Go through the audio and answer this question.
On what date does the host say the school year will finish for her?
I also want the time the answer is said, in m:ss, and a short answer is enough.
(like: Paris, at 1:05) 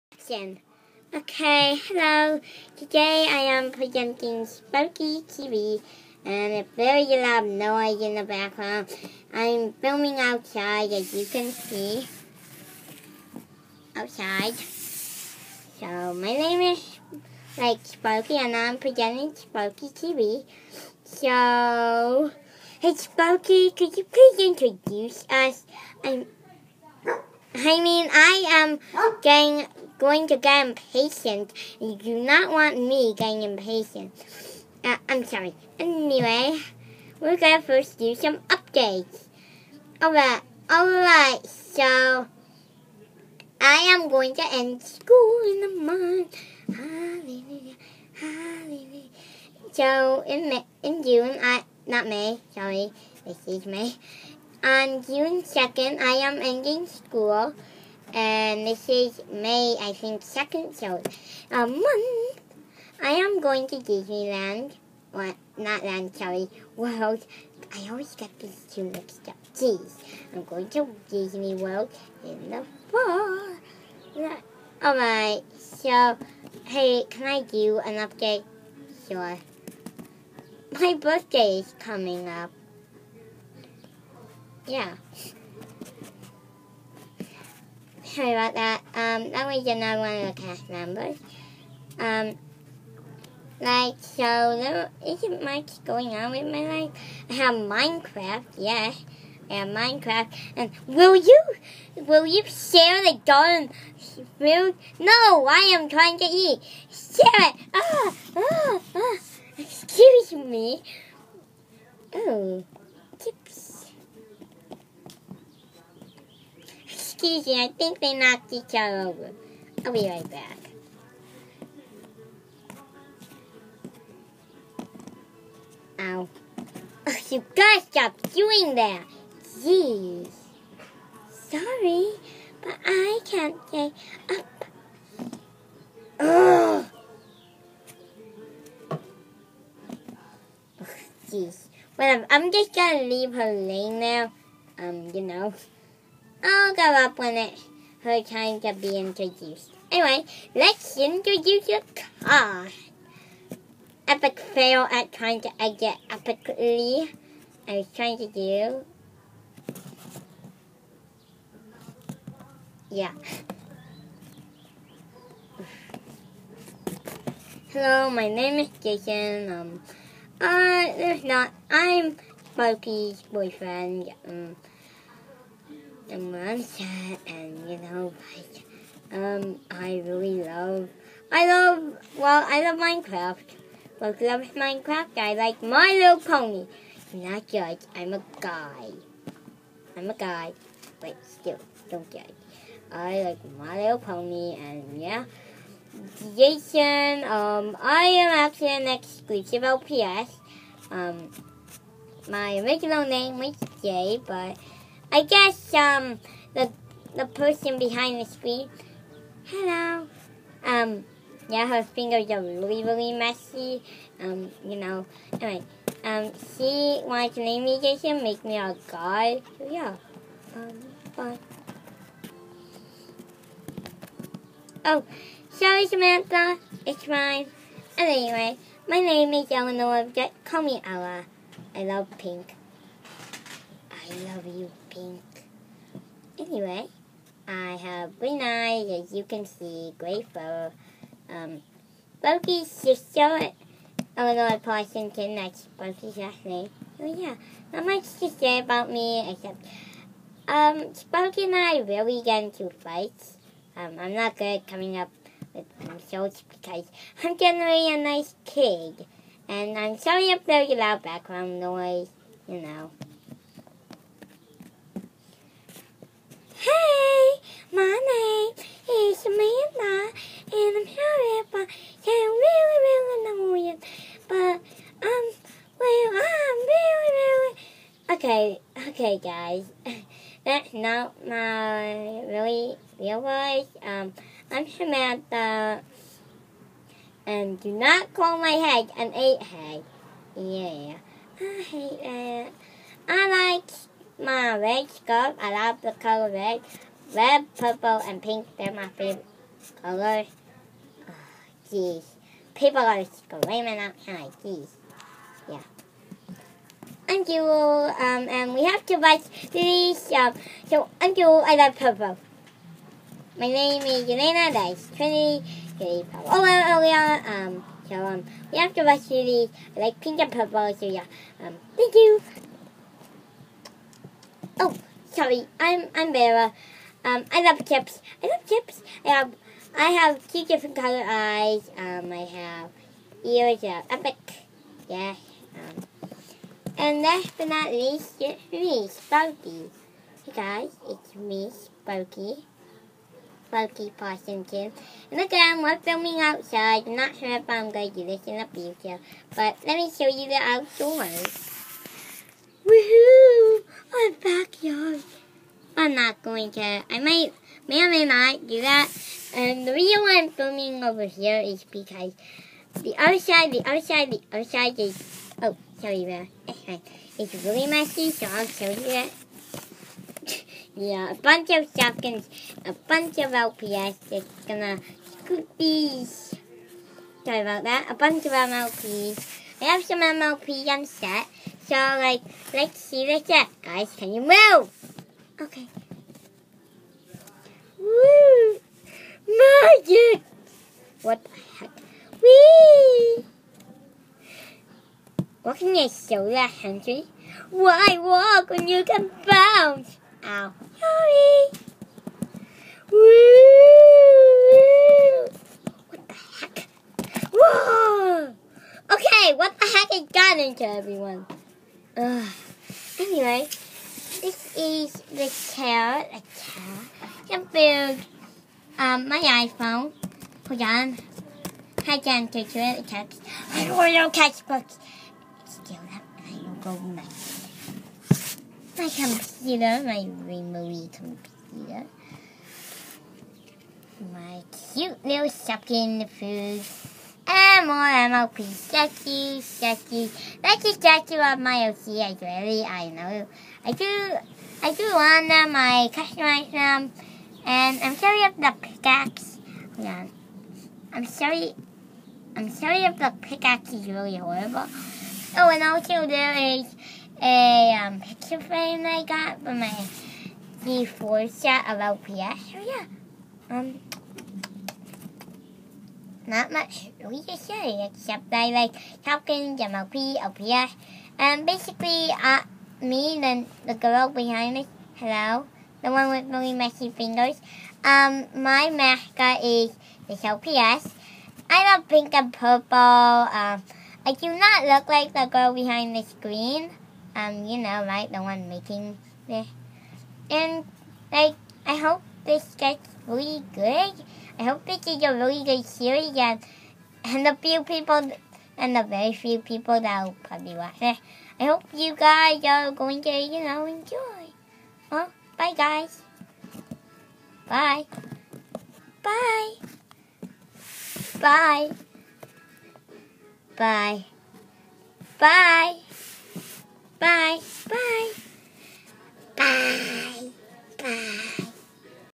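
June 2, at 0:55.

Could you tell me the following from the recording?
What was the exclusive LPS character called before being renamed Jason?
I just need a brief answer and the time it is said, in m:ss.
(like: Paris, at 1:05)
Jay, at 3:23.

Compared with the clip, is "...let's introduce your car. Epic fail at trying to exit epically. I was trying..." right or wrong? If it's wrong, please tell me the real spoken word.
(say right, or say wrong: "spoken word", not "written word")
right.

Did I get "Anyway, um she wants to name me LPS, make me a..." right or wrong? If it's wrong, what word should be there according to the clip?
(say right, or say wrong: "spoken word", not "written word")
wrong: "Jason", not "LPS".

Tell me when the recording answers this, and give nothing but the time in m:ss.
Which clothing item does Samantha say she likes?
4:54.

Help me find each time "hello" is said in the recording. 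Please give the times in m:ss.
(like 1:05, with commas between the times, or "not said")
0:01, 2:47, 3:29, 7:54.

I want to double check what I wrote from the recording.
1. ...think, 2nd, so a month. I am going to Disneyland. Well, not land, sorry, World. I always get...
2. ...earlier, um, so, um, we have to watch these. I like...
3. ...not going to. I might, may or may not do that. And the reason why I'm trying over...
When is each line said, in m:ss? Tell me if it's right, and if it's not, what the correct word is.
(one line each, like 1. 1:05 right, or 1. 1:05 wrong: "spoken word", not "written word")
1. 0:59 right
2. 5:16 right
3. 5:55 wrong: "filming", not "trying".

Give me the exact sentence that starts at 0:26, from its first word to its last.
I'm I mean, I am getting going to get impatient.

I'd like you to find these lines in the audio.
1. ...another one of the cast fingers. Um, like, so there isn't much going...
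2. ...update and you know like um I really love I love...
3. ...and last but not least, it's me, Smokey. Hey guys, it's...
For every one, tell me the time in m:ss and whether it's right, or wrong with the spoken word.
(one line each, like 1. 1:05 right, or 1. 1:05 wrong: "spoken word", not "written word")
1. 1:29 wrong: "members", not "fingers"
2. 2:56 wrong: "website", not "update"
3. 5:36 wrong: "Sparky", not "Smokey".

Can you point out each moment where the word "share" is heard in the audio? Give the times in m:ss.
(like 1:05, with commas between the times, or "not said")
1:42, 1:46.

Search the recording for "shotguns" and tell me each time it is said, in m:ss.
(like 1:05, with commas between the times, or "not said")
6:11.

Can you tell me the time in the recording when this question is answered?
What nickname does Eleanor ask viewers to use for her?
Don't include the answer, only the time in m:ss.
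3:50.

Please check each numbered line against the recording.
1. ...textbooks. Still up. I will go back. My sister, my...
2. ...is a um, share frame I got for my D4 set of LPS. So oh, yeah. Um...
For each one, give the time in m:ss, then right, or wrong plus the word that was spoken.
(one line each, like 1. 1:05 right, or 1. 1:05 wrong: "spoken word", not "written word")
1. 7:04 wrong: "computer", not "sister"
2. 7:36 wrong: "picture", not "share".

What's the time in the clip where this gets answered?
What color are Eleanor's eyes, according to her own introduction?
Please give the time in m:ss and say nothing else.
3:58.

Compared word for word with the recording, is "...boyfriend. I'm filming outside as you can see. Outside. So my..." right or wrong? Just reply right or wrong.
wrong.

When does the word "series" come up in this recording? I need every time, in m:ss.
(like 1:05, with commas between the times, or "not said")
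8:15.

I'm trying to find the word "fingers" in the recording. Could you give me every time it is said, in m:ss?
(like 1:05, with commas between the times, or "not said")
3:31, 7:56.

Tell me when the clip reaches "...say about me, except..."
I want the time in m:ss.
4:08.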